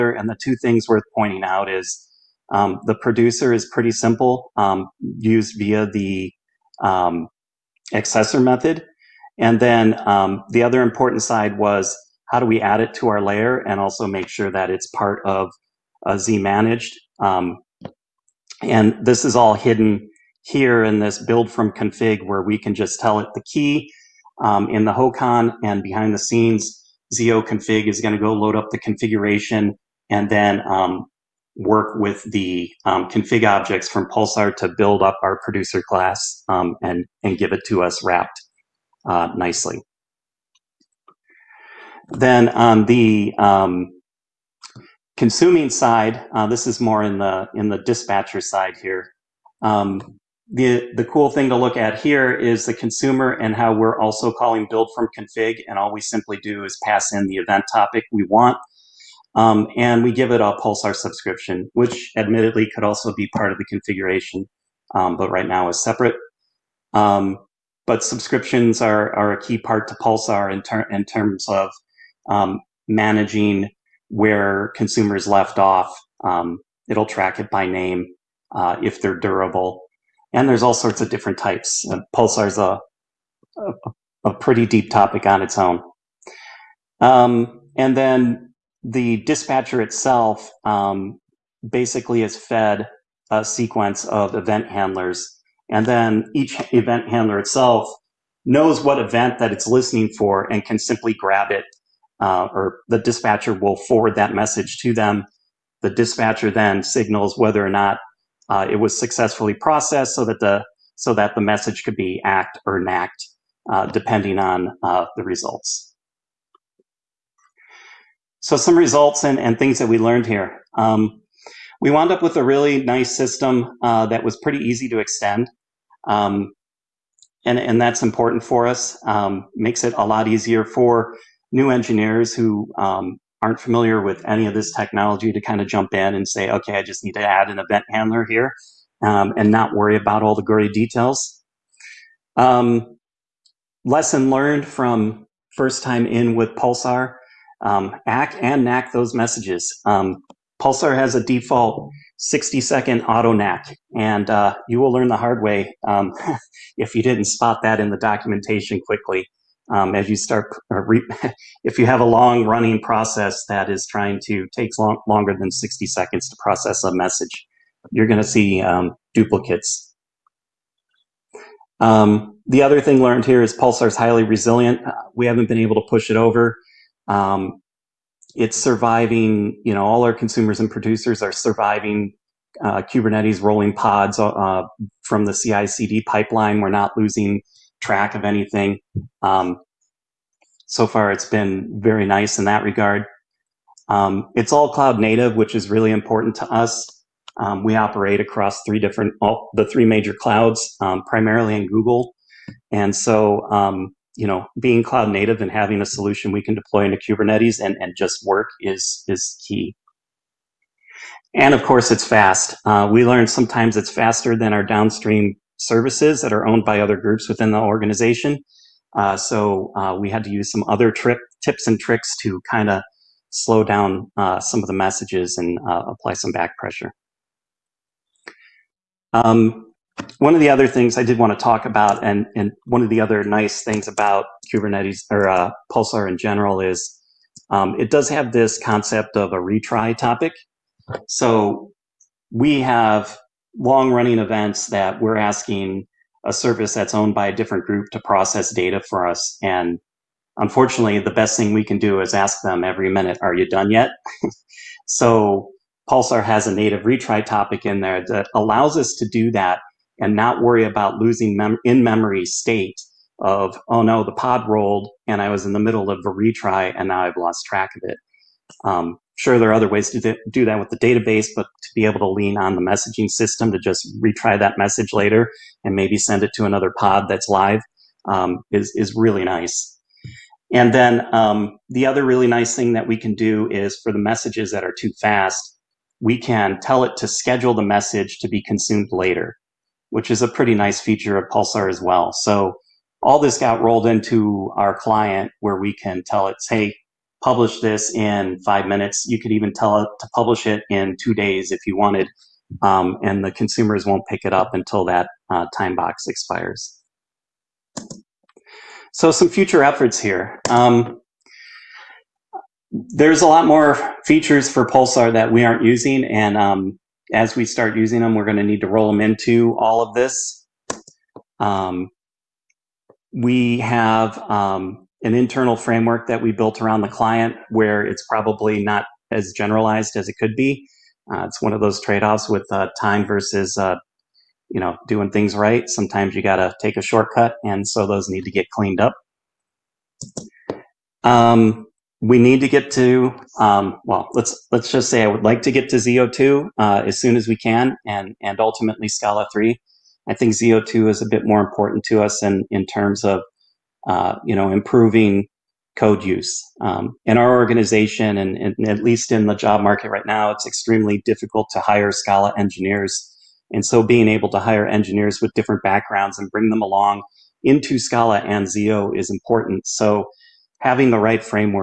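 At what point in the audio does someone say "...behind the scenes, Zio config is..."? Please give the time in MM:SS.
00:25.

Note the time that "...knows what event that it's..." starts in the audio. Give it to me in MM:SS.
01:38.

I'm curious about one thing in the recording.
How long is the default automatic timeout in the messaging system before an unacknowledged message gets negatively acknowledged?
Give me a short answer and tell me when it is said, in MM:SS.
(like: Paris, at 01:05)
60 seconds, at 02:32.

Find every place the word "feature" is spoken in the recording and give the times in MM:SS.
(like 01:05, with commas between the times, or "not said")
04:50, 05:14.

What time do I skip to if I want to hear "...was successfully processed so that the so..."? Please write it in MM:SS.
01:48.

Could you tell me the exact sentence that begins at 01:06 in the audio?
Um, but subscriptions are, are a key part to Pulsar in, ter- in terms of um, managing where consumers left off.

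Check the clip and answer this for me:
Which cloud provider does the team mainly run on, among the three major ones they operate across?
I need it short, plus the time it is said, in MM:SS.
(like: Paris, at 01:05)
Google, at 03:21.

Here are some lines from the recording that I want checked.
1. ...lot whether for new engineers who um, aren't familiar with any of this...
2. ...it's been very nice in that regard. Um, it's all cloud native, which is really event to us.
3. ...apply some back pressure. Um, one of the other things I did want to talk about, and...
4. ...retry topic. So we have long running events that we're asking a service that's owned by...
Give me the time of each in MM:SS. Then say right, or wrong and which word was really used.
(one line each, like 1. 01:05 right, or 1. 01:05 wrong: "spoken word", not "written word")
1. 02:10 wrong: "easier", not "whether"
2. 03:11 wrong: "important", not "event"
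3. 03:45 right
4. 03:59 right.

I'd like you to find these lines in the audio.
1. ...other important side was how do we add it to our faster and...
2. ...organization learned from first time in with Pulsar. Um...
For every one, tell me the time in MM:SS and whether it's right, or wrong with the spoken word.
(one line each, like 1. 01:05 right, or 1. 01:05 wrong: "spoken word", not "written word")
1. 00:10 wrong: "layer", not "faster"
2. 02:23 wrong: "lesson", not "organization".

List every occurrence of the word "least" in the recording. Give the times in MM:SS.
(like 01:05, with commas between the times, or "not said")
05:58.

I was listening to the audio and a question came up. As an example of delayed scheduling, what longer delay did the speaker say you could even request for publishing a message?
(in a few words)
2 days.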